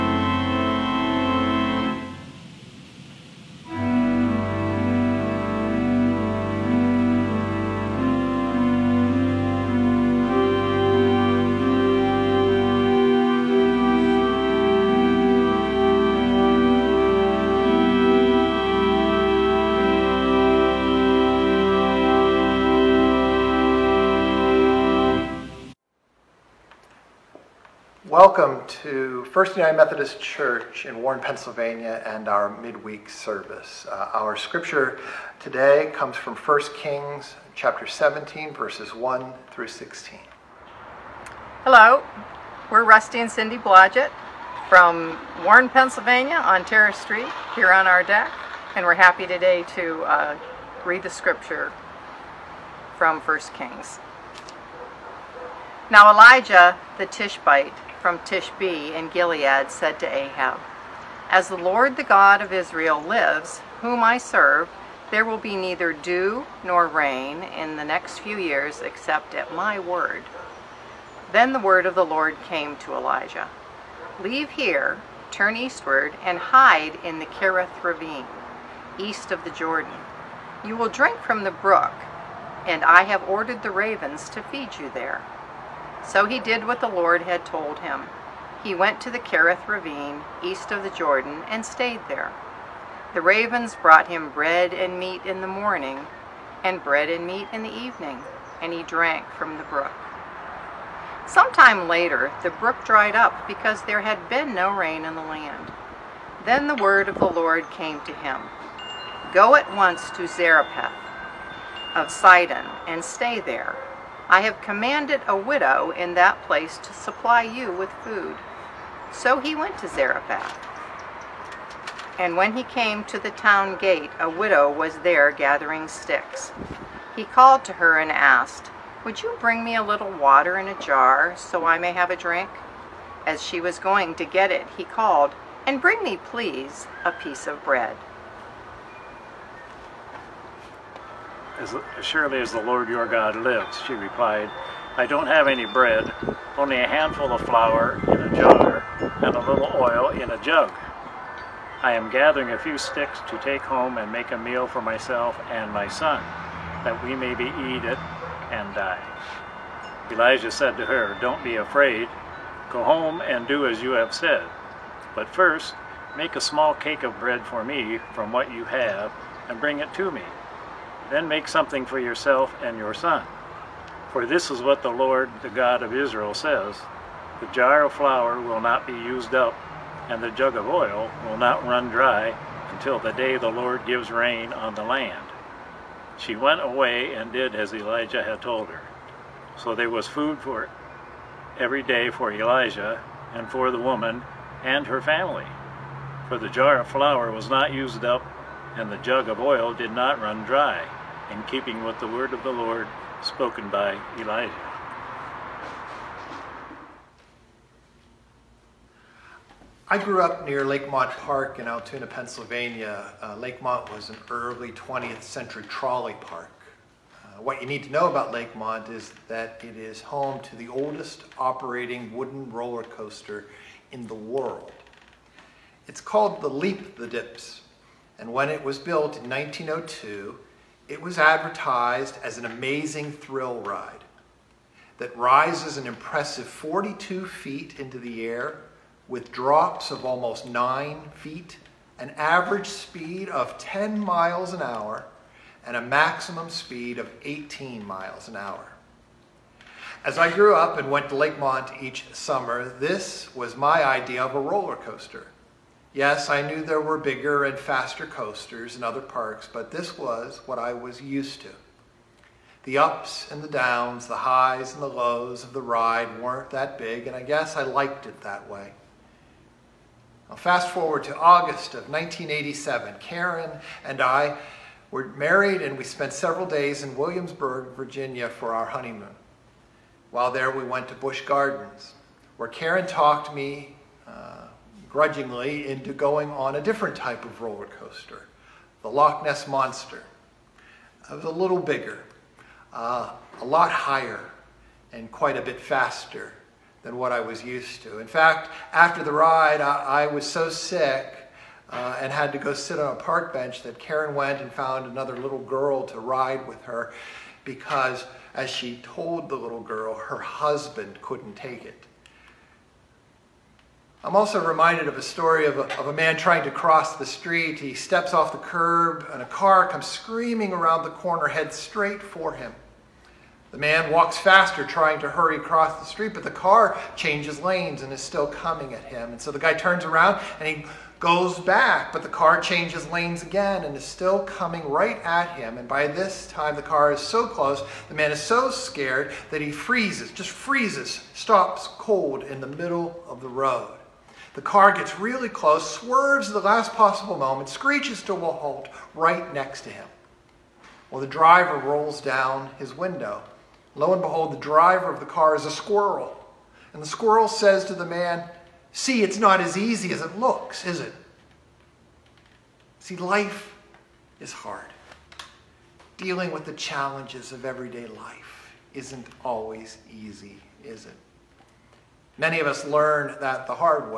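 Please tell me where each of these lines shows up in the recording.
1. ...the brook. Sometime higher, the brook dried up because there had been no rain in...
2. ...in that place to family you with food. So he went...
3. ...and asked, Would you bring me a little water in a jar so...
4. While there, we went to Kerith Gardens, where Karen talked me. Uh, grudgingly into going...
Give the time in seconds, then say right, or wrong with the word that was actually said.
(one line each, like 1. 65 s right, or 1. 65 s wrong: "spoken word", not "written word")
1. 99 s wrong: "later", not "higher"
2. 115 s wrong: "supply", not "family"
3. 127 s right
4. 280 s wrong: "Busch", not "Kerith".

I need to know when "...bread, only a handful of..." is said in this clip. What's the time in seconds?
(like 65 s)
145 s.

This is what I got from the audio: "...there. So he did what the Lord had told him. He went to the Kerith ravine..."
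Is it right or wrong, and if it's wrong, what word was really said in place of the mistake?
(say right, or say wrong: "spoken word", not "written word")
right.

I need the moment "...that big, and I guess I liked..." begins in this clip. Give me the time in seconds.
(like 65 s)
266 s.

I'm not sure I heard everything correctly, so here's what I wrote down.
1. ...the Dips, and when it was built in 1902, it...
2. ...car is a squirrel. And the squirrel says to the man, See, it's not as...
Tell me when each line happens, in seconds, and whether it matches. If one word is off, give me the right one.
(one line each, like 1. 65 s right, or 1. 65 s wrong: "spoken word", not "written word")
1. 226 s right
2. 355 s right.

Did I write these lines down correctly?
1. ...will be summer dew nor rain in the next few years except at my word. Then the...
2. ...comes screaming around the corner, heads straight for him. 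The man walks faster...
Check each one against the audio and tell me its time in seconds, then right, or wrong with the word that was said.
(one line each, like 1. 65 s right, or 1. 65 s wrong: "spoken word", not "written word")
1. 65 s wrong: "neither", not "summer"
2. 319 s right.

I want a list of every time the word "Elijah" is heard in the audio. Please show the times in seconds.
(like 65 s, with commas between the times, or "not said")
56 s, 72 s, 160 s, 187 s, 192 s, 204 s.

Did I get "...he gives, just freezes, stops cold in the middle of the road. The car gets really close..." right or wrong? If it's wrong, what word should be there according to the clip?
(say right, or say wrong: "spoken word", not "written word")
wrong: "freezes", not "gives".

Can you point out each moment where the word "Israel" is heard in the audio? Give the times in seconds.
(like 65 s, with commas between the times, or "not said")
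62 s, 175 s.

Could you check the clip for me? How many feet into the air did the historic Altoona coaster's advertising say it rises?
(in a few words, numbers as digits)
42 feet.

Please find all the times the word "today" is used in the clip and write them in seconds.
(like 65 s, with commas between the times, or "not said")
35 s, 49 s.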